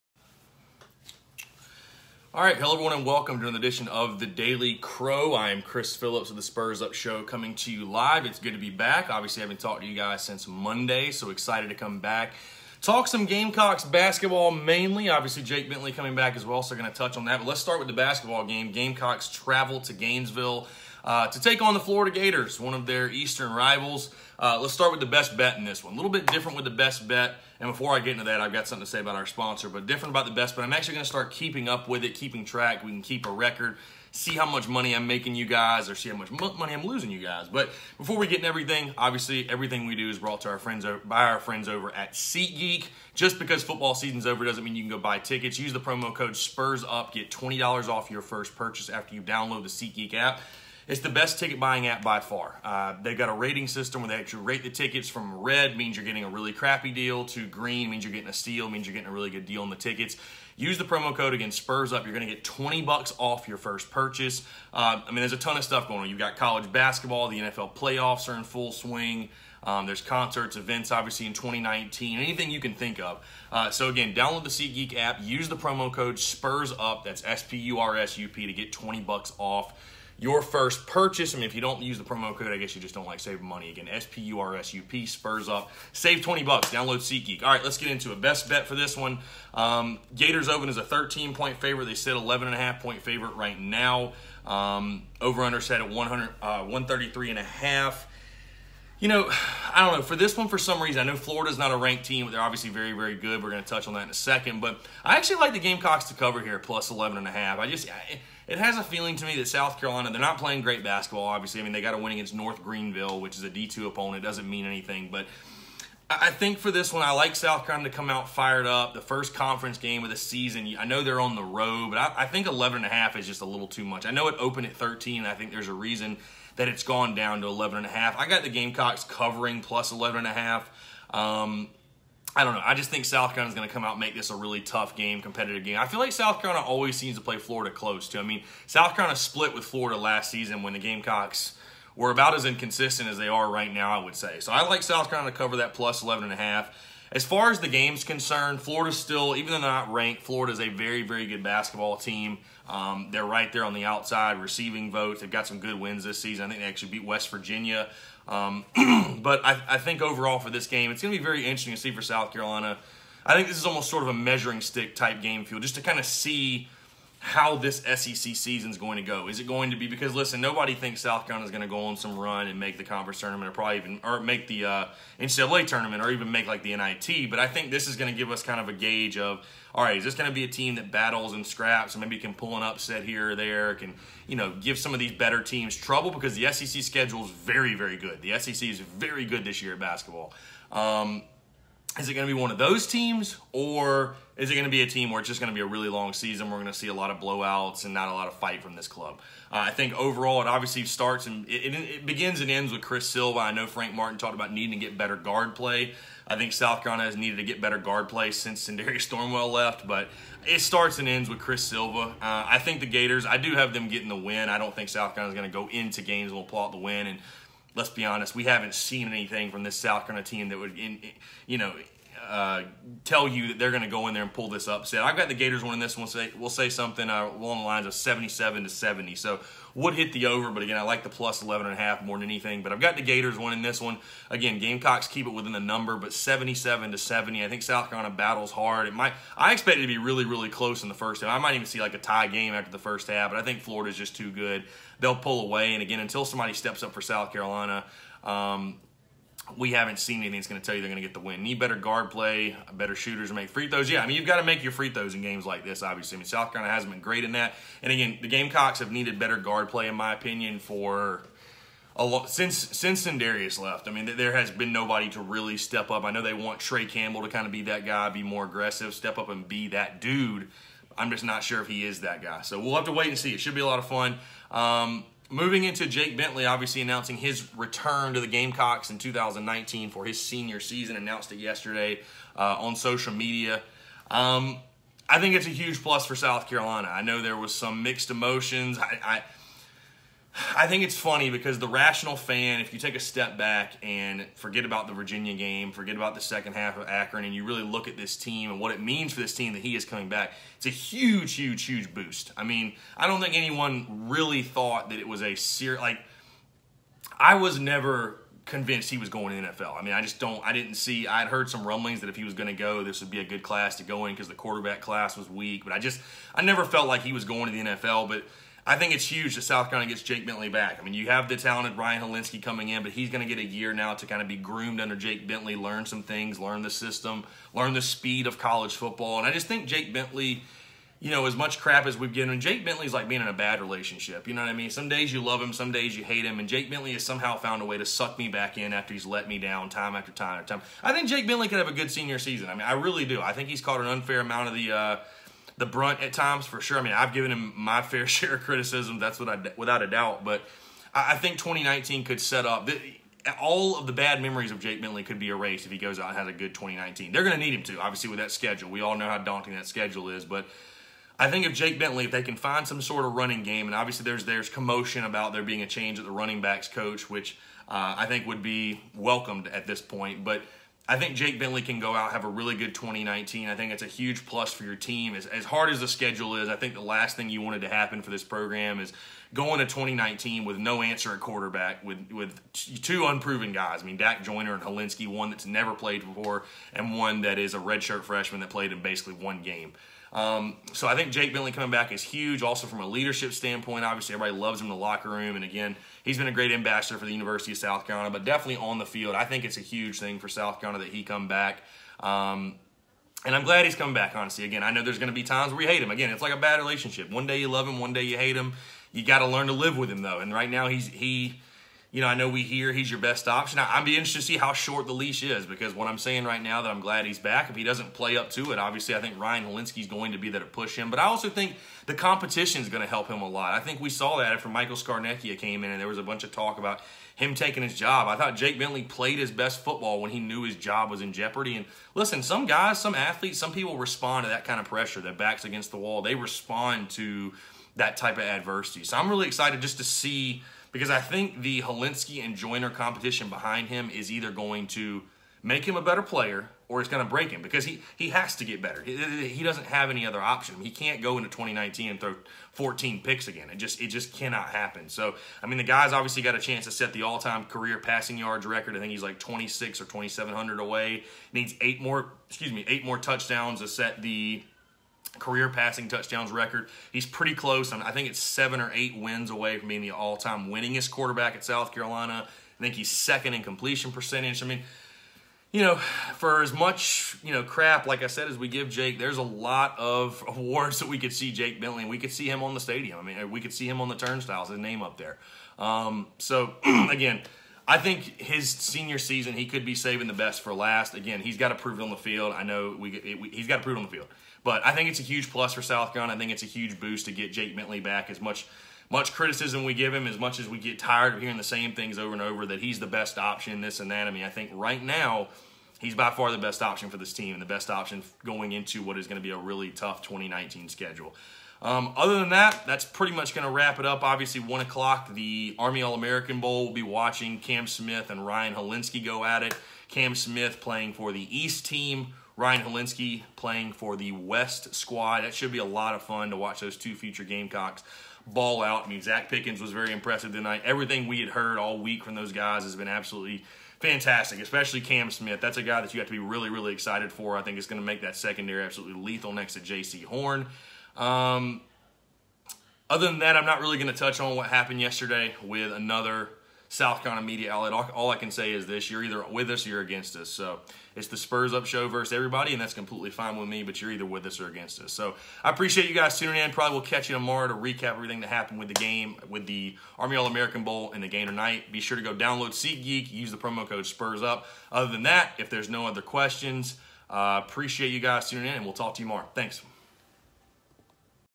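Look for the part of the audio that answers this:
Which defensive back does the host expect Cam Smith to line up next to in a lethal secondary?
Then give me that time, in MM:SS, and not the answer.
08:59.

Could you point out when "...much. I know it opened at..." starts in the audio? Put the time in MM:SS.
02:03.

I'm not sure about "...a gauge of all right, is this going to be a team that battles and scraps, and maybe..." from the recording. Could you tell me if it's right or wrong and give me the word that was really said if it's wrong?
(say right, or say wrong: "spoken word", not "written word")
right.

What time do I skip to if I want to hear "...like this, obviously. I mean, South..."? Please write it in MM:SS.
04:15.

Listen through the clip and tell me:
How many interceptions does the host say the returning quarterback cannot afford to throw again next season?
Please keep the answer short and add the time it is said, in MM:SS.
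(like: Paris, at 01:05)
14, at 07:32.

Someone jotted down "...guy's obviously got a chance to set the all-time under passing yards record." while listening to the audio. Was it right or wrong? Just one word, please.
wrong.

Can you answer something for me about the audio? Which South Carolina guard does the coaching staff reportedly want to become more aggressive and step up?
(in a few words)
Tre Campbell.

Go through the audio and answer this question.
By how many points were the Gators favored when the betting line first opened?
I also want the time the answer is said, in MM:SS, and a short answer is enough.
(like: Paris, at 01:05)
13, at 01:30.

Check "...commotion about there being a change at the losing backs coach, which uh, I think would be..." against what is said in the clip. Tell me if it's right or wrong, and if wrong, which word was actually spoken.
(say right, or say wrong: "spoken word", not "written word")
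wrong: "running", not "losing".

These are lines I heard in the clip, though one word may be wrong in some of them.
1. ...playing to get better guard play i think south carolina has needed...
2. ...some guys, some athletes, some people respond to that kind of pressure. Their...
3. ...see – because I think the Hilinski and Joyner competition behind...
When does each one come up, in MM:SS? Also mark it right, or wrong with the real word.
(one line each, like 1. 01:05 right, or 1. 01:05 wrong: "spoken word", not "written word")
1. 03:24 wrong: "needing", not "playing"
2. 07:12 right
3. 07:19 right.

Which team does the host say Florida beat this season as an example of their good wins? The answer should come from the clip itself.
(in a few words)
West Virginia.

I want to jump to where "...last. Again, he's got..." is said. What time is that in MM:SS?
08:10.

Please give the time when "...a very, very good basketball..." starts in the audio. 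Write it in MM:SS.
02:30.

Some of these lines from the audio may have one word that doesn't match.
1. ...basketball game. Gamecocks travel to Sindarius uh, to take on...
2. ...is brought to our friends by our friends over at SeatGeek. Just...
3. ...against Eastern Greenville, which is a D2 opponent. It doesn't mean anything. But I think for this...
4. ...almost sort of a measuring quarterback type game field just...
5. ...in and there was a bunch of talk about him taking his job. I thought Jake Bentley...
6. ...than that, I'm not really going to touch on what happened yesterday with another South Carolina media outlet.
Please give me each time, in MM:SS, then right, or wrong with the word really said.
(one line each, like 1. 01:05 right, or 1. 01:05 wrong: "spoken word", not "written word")
1. 00:17 wrong: "Gainesville", not "Sindarius"
2. 00:40 right
3. 01:52 wrong: "North", not "Eastern"
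4. 02:43 wrong: "stick", not "quarterback"
5. 07:05 right
6. 09:03 right.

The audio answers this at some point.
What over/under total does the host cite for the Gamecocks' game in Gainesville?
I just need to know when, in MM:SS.
01:36.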